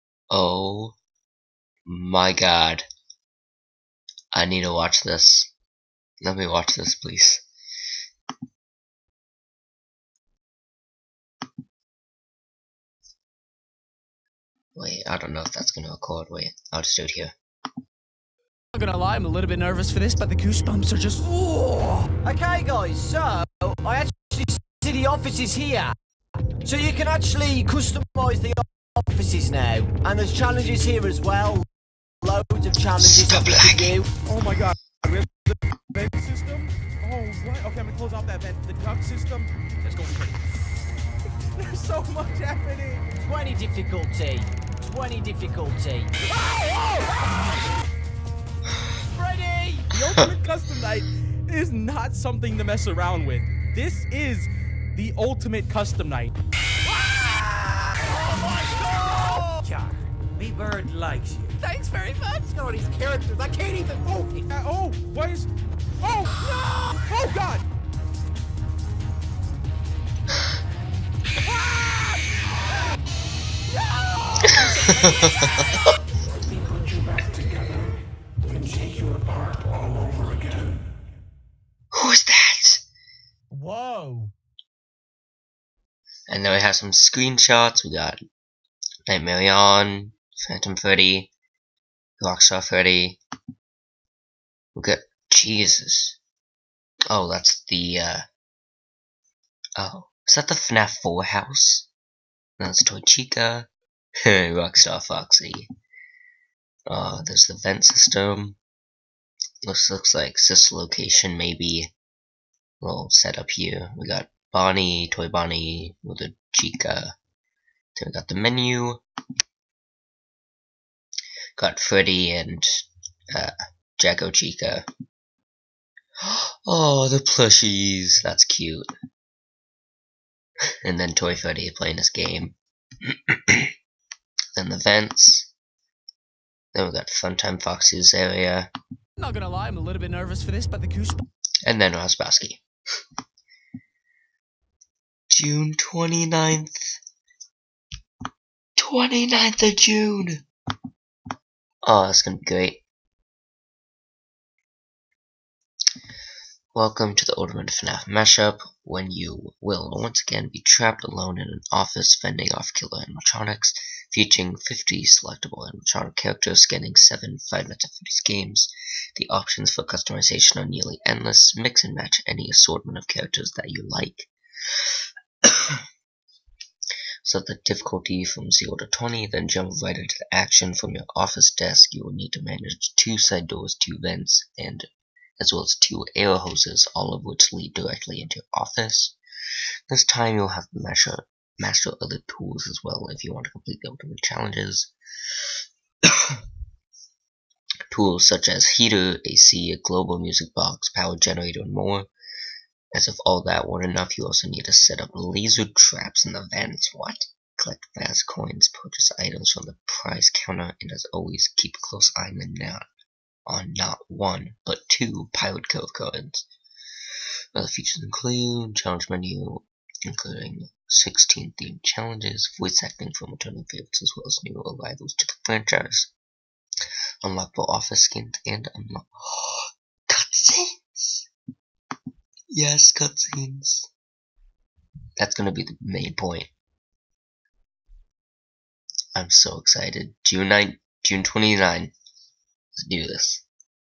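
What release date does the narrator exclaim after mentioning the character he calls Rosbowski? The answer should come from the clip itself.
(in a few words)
June 29th.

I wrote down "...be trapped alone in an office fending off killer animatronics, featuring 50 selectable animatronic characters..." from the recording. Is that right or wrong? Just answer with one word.
right.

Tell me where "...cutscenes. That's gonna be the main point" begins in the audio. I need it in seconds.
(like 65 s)
232 s.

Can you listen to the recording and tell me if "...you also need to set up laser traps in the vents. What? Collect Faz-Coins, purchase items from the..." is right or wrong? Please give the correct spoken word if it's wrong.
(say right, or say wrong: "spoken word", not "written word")
right.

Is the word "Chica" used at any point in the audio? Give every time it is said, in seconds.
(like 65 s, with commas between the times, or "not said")
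103 s, 116 s, 124 s.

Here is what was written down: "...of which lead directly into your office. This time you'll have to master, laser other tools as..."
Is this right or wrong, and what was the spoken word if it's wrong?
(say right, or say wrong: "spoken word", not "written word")
wrong: "master", not "laser".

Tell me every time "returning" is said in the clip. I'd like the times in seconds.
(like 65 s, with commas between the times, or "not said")
223 s.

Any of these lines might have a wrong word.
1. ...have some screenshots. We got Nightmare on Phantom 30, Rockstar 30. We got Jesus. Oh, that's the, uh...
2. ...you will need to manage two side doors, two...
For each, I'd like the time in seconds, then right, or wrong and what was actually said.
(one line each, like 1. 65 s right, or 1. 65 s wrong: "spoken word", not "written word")
1. 86 s right
2. 181 s right.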